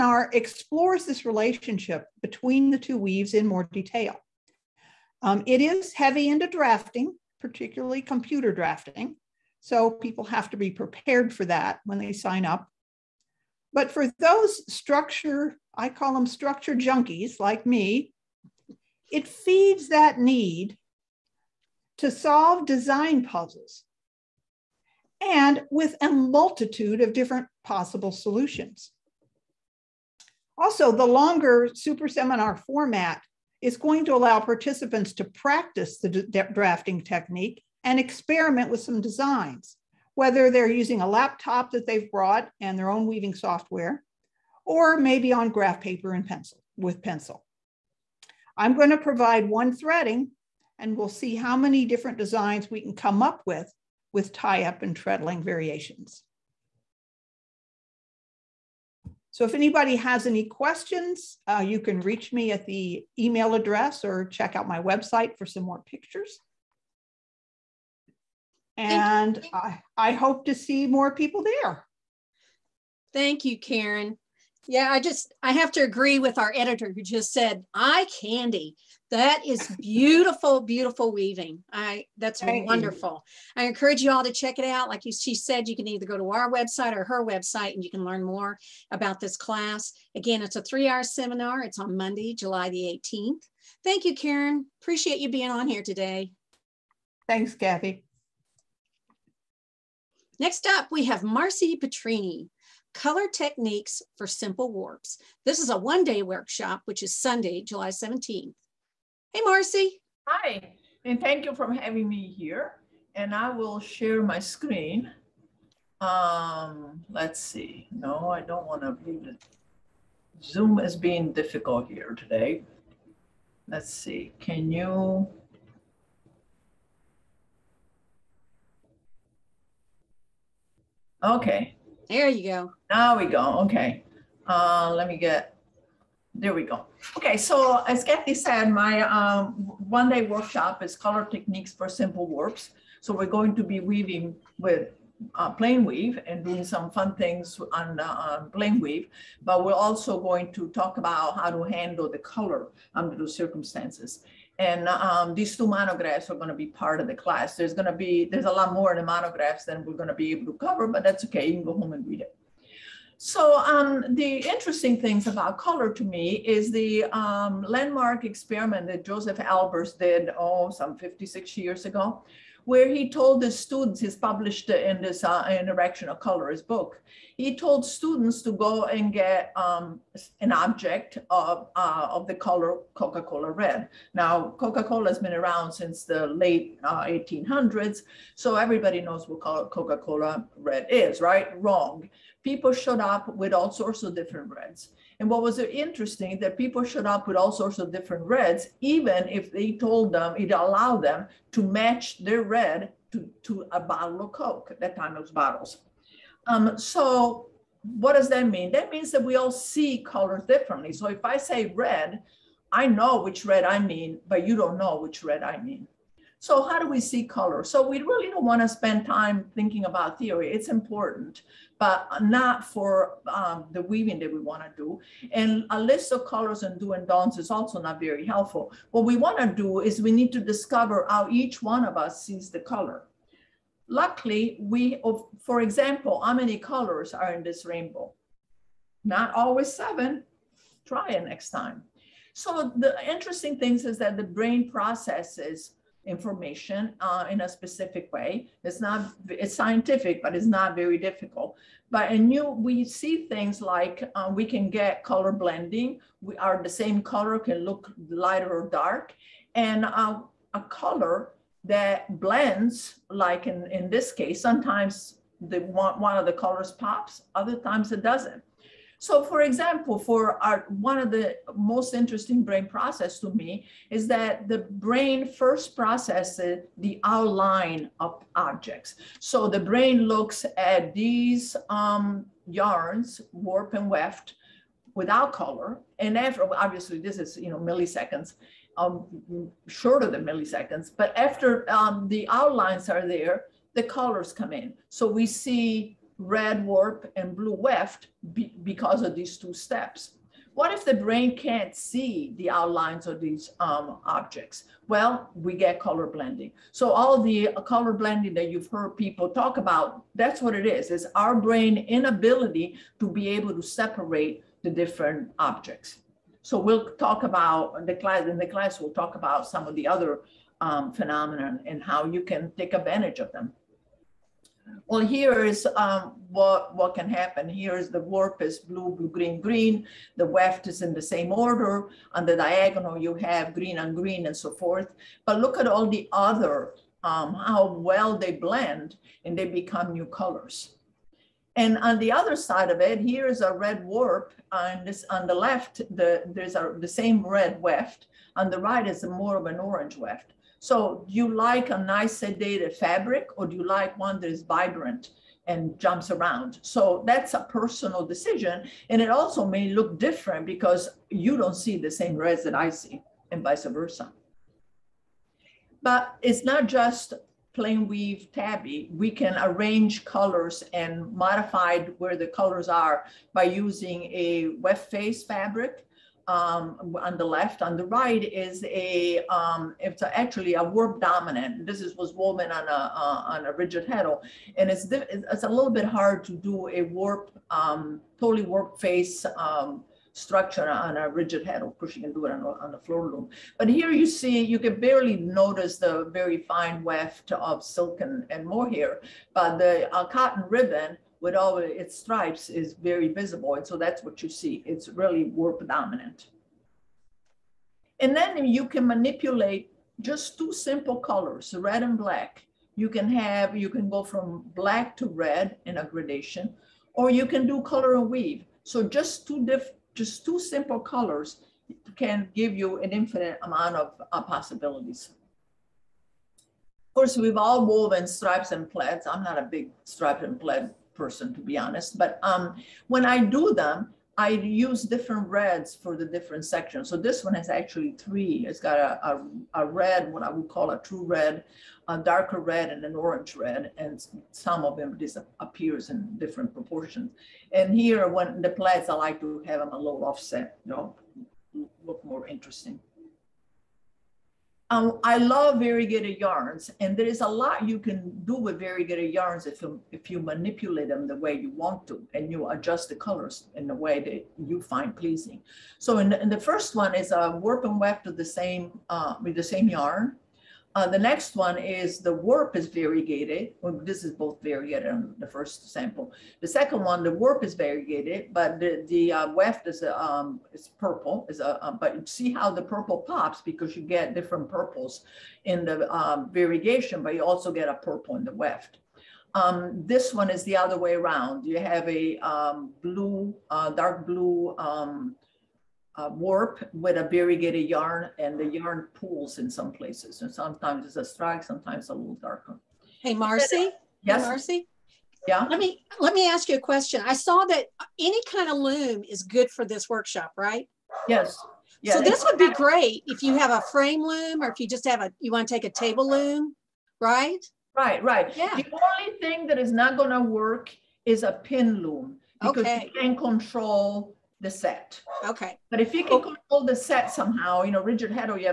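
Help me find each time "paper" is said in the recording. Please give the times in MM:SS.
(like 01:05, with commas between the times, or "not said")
00:45.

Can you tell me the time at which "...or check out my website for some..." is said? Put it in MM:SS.
01:04.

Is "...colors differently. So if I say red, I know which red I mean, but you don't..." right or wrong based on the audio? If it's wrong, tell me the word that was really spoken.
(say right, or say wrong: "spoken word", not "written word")
right.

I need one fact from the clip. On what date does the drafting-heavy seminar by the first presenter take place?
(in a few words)
Monday, July 18th.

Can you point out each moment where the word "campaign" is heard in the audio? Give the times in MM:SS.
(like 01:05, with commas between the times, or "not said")
not said.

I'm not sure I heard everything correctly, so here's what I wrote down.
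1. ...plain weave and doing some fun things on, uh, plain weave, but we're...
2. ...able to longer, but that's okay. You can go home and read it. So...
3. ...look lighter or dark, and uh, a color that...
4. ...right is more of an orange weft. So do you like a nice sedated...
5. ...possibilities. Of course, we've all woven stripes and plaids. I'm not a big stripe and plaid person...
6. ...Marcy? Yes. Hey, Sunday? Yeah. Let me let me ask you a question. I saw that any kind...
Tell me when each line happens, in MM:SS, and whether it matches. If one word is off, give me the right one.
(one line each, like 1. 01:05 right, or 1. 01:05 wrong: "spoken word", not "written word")
1. 02:25 right
2. 02:40 wrong: "cover", not "longer"
3. 04:17 right
4. 05:48 right
5. 07:04 right
6. 08:23 wrong: "Marcy", not "Sunday".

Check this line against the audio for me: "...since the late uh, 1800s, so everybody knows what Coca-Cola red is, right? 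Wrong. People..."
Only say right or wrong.
right.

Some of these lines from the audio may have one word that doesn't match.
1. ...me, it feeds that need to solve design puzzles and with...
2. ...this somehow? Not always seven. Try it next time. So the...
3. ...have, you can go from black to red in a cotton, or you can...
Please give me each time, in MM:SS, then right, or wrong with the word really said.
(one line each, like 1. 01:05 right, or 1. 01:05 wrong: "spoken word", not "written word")
1. 00:17 right
2. 03:57 wrong: "rainbow", not "somehow"
3. 06:53 wrong: "gradation", not "cotton".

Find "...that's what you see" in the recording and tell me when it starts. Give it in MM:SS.
06:43.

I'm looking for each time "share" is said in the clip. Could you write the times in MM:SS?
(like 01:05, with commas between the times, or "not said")
01:53.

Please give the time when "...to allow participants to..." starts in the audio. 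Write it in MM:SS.
00:34.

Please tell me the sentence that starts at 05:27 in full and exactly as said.
Here is the warp is blue, blue, green, green.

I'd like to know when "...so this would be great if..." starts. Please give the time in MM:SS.
08:31.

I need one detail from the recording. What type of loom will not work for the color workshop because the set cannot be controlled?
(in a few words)
Pin loom.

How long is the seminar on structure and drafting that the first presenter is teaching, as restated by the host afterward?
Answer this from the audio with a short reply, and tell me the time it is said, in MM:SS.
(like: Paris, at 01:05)
3 hours, at 01:30.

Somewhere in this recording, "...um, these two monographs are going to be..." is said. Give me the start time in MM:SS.
02:34.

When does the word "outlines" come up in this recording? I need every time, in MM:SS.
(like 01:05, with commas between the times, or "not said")
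04:37, 04:52, 05:02.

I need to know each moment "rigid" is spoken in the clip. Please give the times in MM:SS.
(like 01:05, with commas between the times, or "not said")
06:23, 06:31, 08:47.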